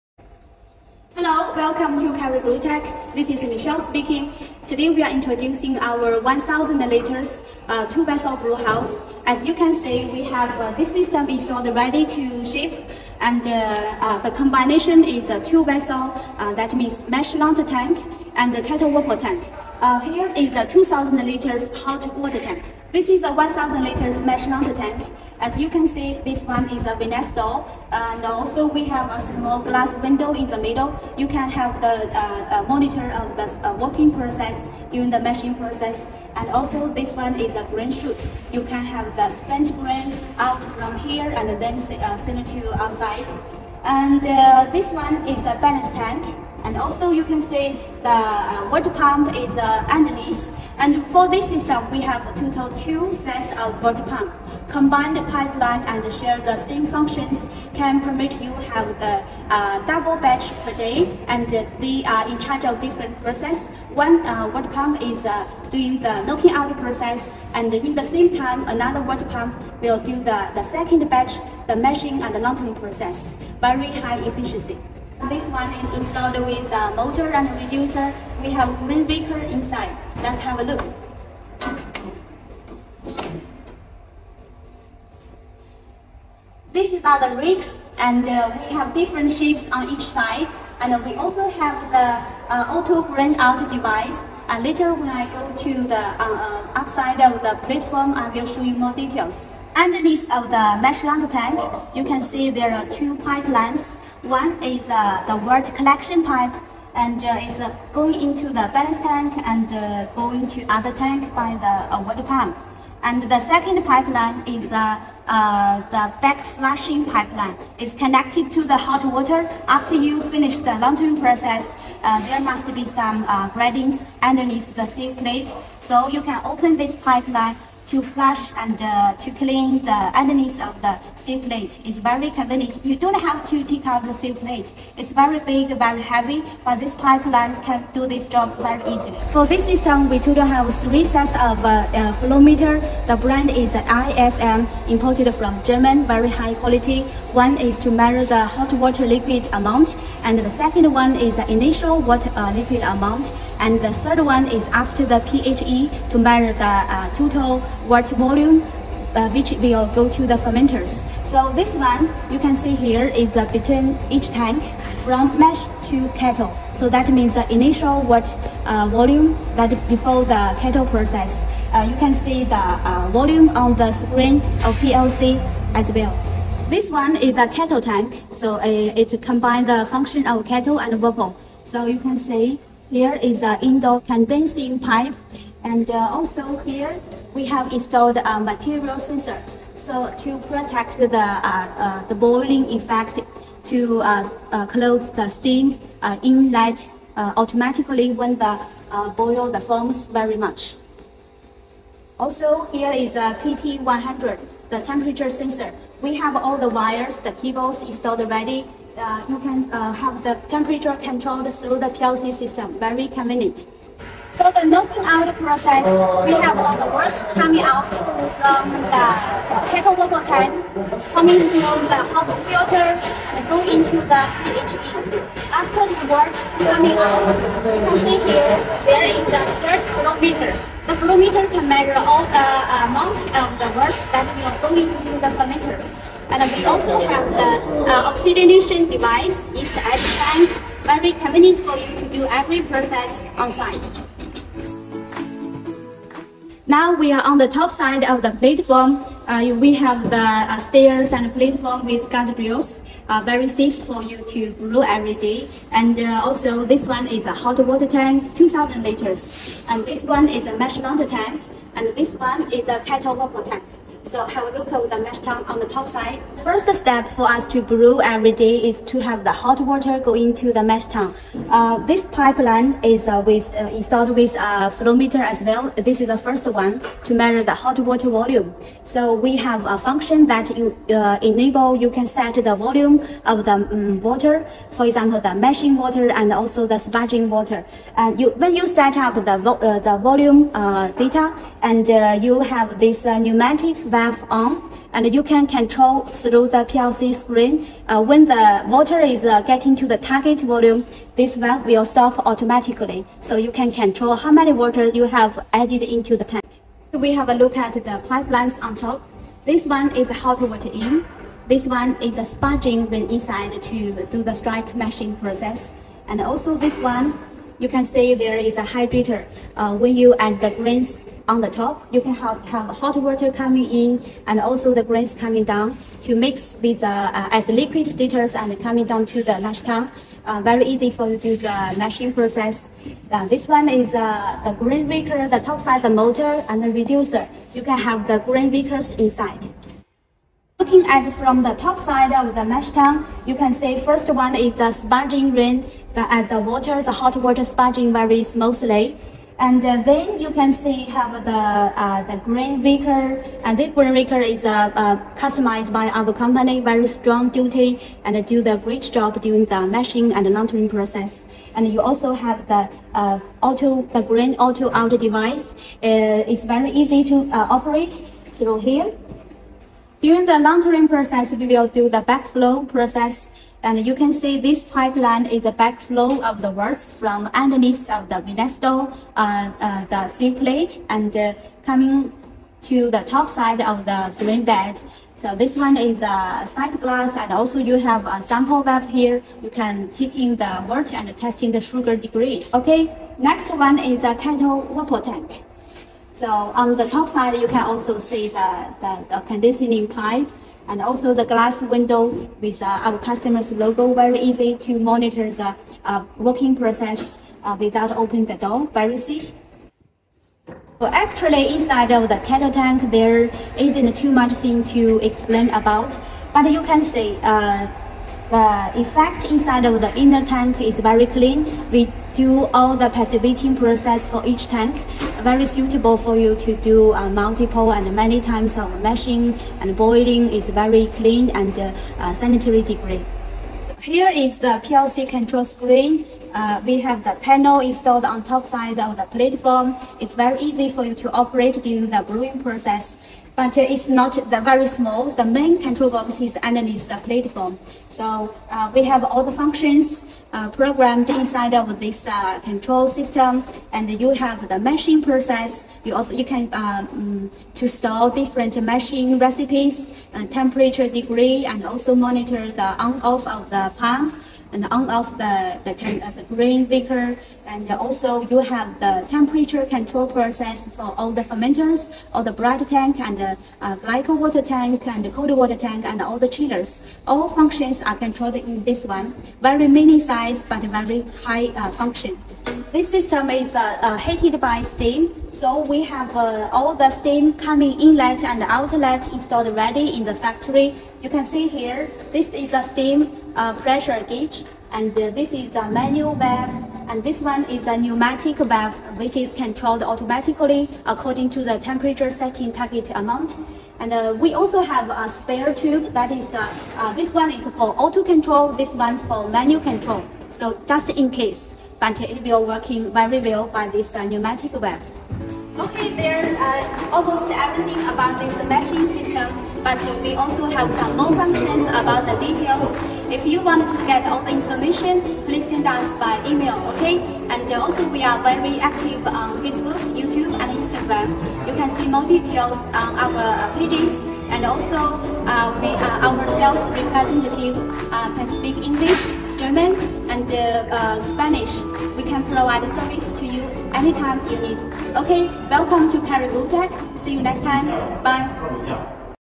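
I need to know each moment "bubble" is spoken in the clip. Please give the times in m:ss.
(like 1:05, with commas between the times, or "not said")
3:00, 3:39.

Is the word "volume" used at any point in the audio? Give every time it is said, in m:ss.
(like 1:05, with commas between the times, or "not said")
2:38, 2:48, 2:53, 4:38, 4:42, 4:50, 5:00.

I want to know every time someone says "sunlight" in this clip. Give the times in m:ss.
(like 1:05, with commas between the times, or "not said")
not said.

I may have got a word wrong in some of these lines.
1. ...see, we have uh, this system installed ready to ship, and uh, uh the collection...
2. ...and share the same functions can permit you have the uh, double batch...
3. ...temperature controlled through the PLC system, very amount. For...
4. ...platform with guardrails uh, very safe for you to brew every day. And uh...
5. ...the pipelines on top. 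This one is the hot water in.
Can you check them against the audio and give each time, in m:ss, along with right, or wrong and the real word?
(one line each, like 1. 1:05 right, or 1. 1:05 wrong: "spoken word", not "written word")
1. 0:09 wrong: "combination", not "collection"
2. 0:55 right
3. 3:30 wrong: "convenient", not "amount"
4. 4:11 right
5. 5:07 right.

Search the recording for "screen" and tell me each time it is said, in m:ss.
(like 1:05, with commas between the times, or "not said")
2:53, 4:57, 7:15.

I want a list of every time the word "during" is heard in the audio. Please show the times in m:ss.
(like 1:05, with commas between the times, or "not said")
0:34, 5:59, 6:10, 7:21.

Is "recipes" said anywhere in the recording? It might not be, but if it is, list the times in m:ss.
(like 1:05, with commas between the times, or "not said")
7:39.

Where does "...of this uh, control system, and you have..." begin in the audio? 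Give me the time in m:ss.
7:31.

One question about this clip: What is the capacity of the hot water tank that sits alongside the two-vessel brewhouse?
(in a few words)
2,000 liters.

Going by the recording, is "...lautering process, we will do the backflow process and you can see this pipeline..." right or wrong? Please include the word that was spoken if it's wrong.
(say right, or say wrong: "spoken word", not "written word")
right.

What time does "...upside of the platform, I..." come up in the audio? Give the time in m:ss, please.
1:36.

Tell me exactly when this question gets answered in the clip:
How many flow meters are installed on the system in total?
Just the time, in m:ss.
2:20.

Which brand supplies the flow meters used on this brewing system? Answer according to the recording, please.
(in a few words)
IFM.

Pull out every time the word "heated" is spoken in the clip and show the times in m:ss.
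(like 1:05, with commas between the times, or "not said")
8:03.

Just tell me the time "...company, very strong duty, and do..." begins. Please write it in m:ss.
5:56.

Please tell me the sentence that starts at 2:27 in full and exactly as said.
One is to measure the hot water liquid amount, and the second one is the initial water uh, liquid amount.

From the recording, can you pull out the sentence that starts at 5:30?
Uh, very easy for you to do the lashing process.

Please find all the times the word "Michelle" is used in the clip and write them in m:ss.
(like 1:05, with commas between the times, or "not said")
0:03.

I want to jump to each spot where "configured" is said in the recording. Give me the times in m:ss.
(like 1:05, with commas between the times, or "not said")
not said.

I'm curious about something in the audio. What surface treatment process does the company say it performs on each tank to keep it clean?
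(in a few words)
Passivating.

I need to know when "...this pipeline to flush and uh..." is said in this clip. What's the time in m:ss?
2:06.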